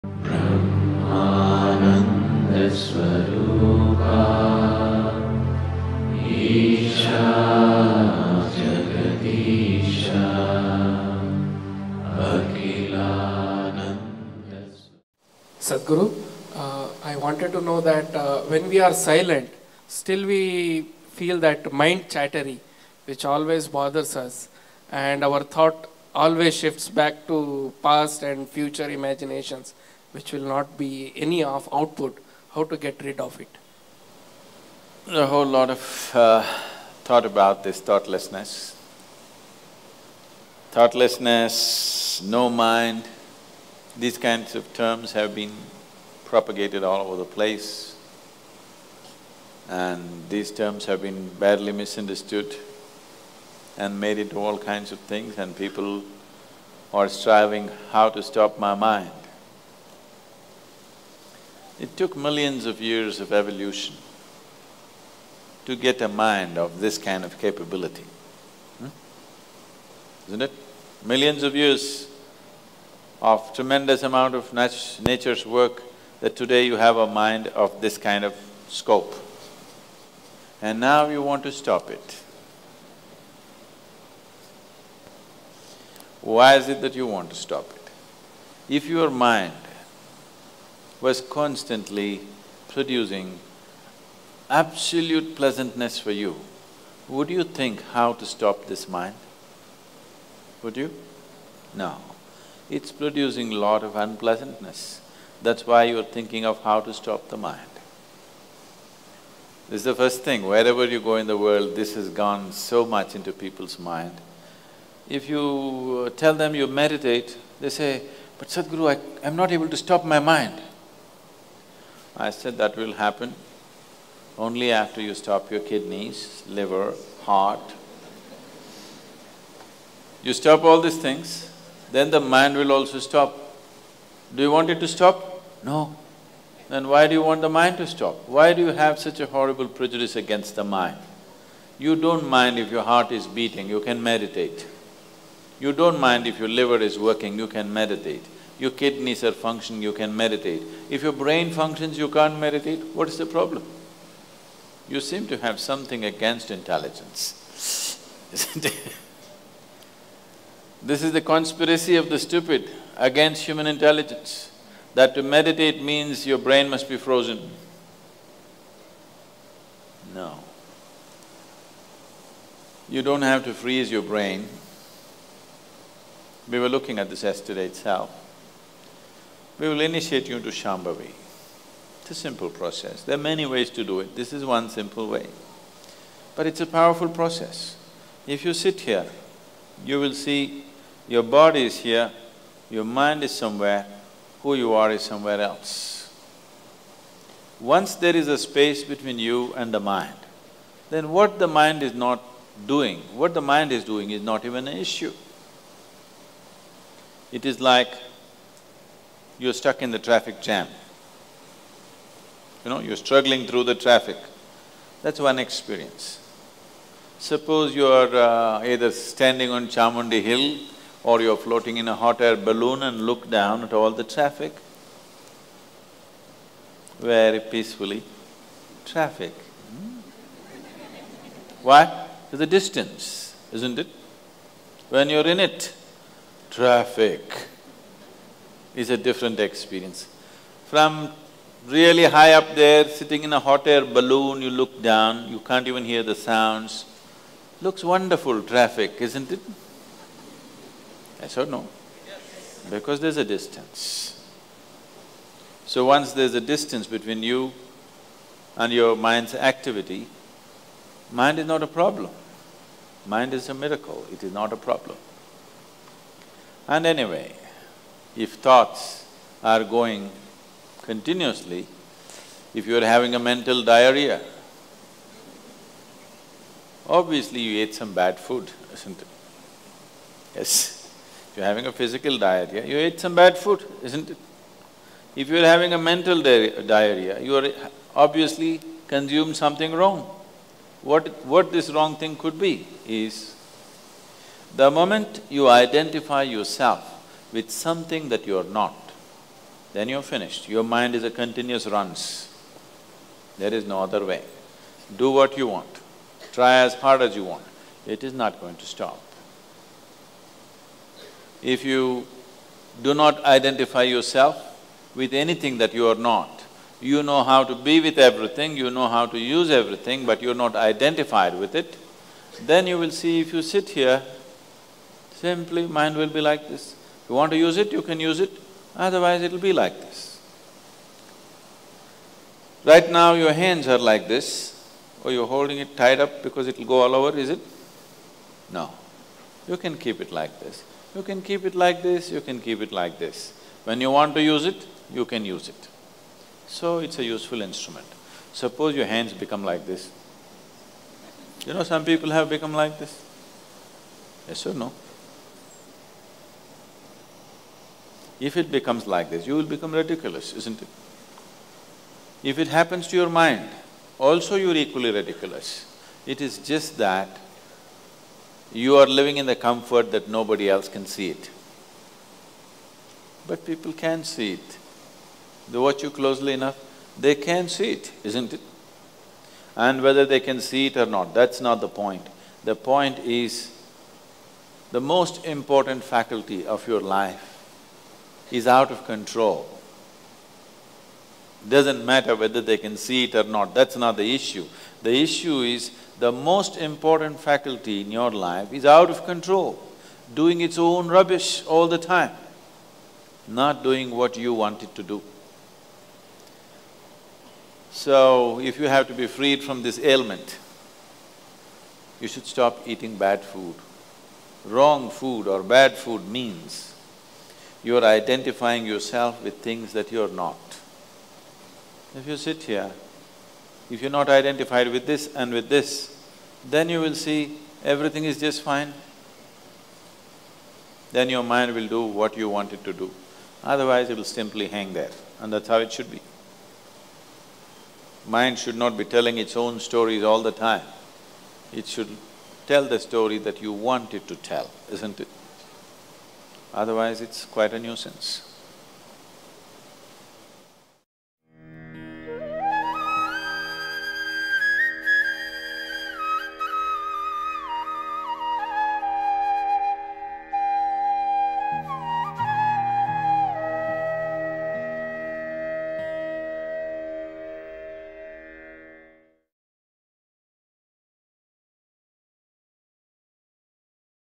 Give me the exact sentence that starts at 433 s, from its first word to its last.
Otherwise, it will simply hang there, and that's how it should be.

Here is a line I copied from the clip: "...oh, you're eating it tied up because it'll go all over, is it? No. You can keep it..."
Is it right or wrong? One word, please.
wrong.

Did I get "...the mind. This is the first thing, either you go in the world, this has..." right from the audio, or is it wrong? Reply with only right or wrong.
wrong.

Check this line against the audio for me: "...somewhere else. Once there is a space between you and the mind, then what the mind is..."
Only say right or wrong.
right.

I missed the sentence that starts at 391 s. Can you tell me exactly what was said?
Doesn't matter whether they can see it or not, that's not the issue.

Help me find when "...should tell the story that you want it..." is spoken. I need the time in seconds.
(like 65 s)
441 s.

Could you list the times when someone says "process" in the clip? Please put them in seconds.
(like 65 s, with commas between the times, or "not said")
182 s, 187 s.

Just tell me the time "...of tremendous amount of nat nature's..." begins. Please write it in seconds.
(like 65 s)
73 s.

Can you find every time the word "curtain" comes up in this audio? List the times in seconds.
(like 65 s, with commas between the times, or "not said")
not said.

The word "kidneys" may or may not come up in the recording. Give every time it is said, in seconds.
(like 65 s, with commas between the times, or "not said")
125 s, 148 s.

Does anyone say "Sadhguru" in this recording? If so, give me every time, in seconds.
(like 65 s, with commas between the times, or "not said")
15 s, 118 s.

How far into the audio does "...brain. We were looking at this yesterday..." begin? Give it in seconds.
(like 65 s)
174 s.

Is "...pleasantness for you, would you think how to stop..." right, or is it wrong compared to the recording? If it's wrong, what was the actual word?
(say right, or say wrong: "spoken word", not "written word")
right.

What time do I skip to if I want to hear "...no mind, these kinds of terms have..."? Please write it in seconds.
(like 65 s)
42 s.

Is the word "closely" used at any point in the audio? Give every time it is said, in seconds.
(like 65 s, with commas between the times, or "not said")
375 s.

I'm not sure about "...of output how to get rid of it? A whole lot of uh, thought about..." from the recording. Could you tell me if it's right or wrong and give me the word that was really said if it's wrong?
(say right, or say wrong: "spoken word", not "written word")
right.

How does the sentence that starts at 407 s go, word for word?
So, if you have to be freed from this ailment, you should stop eating bad food.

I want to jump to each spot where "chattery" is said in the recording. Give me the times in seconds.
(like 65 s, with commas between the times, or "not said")
22 s.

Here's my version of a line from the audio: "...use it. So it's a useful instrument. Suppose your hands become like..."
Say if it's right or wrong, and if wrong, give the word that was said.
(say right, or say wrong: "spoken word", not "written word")
right.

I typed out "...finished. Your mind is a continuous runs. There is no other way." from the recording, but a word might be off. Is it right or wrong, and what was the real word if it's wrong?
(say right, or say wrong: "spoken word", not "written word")
right.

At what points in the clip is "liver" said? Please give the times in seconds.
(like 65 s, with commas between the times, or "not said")
126 s, 146 s.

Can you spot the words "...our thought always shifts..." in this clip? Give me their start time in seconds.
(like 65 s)
25 s.